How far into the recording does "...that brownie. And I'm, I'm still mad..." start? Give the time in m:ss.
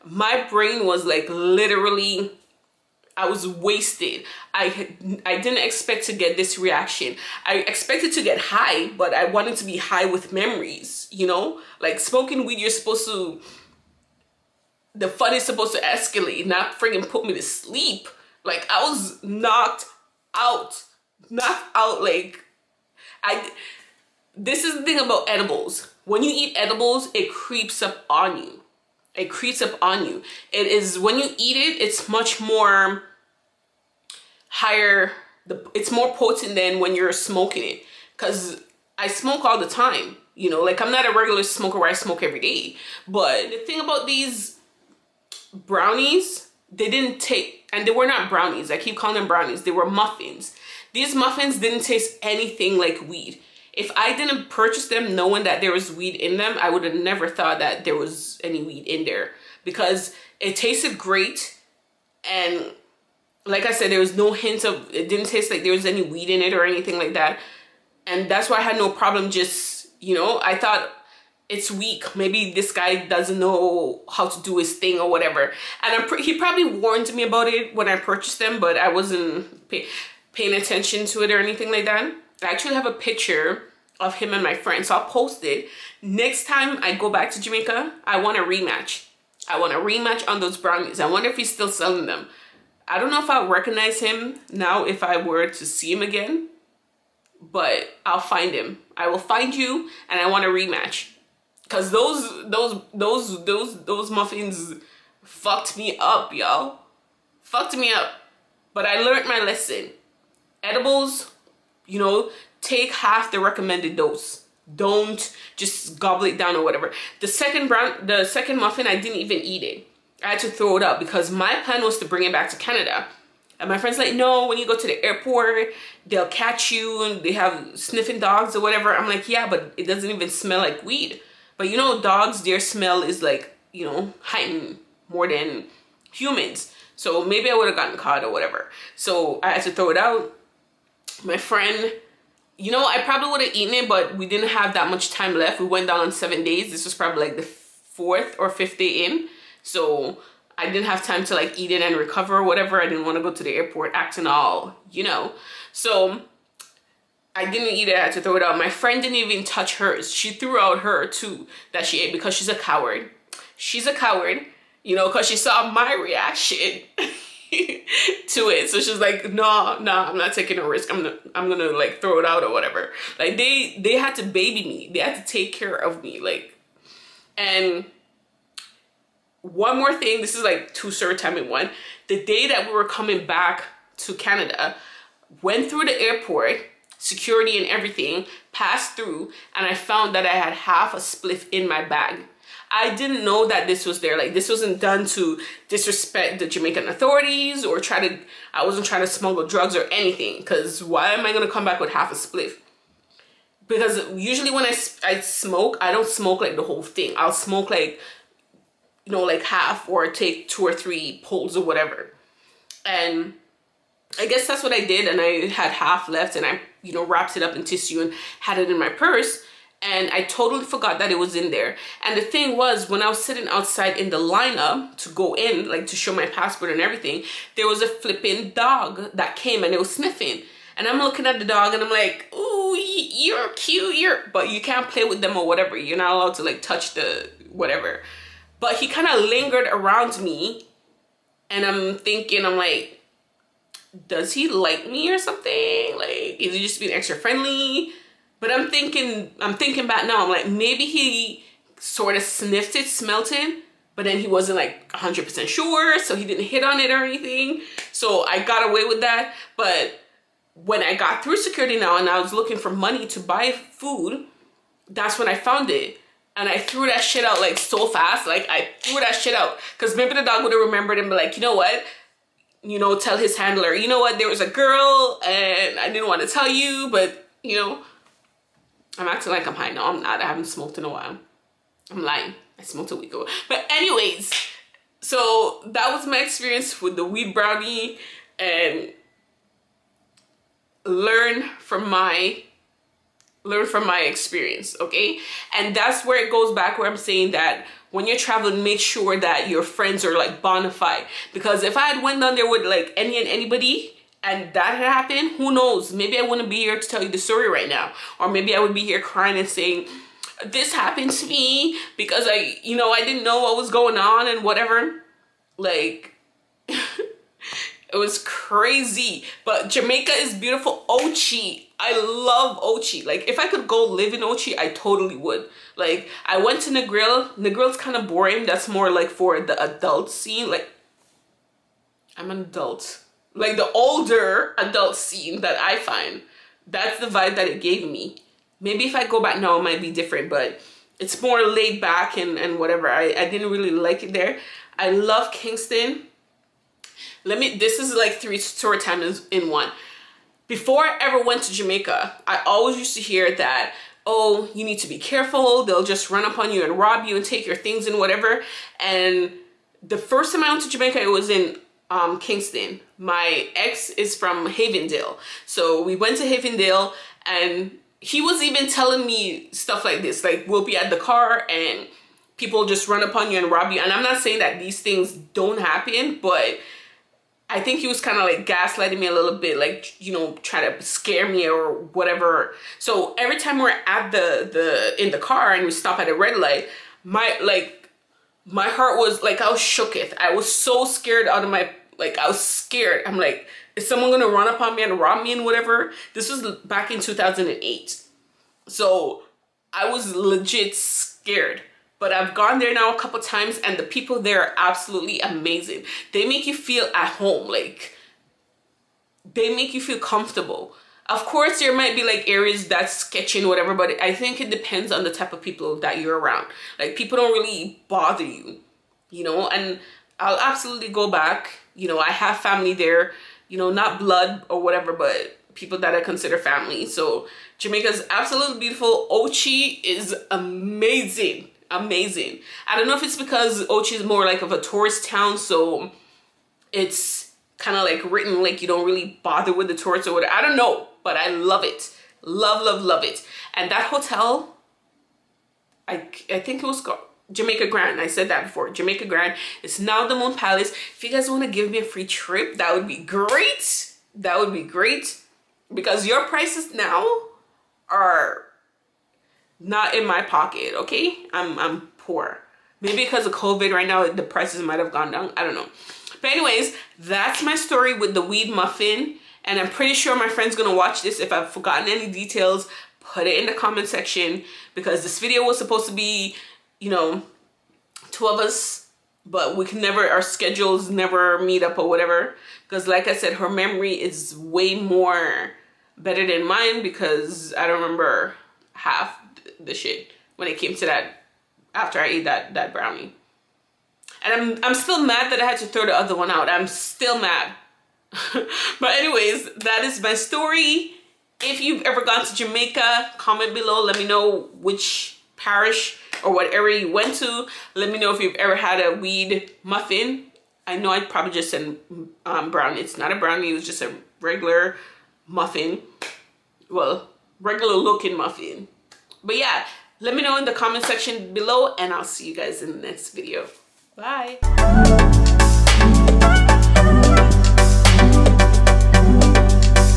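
8:12.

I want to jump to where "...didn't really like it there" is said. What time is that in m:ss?
5:43.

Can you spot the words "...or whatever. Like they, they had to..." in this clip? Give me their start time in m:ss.
2:52.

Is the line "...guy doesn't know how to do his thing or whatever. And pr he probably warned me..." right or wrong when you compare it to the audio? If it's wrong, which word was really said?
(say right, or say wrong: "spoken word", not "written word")
right.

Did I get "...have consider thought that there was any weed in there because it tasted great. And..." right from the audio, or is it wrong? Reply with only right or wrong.
wrong.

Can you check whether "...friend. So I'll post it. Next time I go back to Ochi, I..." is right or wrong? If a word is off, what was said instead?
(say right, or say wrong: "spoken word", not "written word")
wrong: "Jamaica", not "Ochi".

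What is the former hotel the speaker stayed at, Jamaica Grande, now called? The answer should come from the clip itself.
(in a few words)
Moon Palace.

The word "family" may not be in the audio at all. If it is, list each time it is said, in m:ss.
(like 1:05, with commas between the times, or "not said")
7:02, 7:06.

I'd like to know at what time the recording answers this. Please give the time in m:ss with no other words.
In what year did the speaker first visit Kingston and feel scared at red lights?
6:36.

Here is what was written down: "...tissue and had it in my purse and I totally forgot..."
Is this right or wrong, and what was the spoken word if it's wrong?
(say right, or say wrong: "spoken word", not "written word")
right.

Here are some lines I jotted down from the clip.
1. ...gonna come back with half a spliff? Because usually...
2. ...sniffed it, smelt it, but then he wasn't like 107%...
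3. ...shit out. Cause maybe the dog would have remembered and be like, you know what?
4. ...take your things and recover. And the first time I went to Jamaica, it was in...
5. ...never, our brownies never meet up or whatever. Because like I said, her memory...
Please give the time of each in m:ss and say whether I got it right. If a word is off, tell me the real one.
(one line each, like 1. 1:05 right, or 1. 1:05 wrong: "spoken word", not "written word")
1. 3:21 right
2. 4:12 wrong: "100", not "107"
3. 4:29 right
4. 5:57 wrong: "whatever", not "recover"
5. 7:59 wrong: "schedules", not "brownies".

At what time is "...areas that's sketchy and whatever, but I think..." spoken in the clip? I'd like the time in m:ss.
6:52.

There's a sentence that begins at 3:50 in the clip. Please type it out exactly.
And I'm looking at the dog and I'm like, ooh, you're cute, you're, but you can't play with them or whatever.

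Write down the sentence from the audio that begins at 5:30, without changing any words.
Like, I'm an adult like the older adult scene that I find.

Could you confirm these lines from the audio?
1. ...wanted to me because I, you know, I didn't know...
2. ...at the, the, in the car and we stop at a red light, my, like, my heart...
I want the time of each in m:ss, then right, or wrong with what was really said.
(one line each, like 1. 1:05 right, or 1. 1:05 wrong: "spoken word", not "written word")
1. 5:10 wrong: "happened", not "wanted"
2. 6:23 right.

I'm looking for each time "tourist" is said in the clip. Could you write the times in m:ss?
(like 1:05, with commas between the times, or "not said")
7:14, 7:19.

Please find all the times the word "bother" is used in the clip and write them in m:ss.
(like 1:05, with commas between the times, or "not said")
6:57, 7:19.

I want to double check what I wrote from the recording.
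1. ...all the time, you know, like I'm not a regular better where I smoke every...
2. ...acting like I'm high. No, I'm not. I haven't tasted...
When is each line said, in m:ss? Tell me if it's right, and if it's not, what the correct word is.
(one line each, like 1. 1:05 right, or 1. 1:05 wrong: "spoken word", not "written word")
1. 0:39 wrong: "smoker", not "better"
2. 4:39 wrong: "smoked", not "tasted".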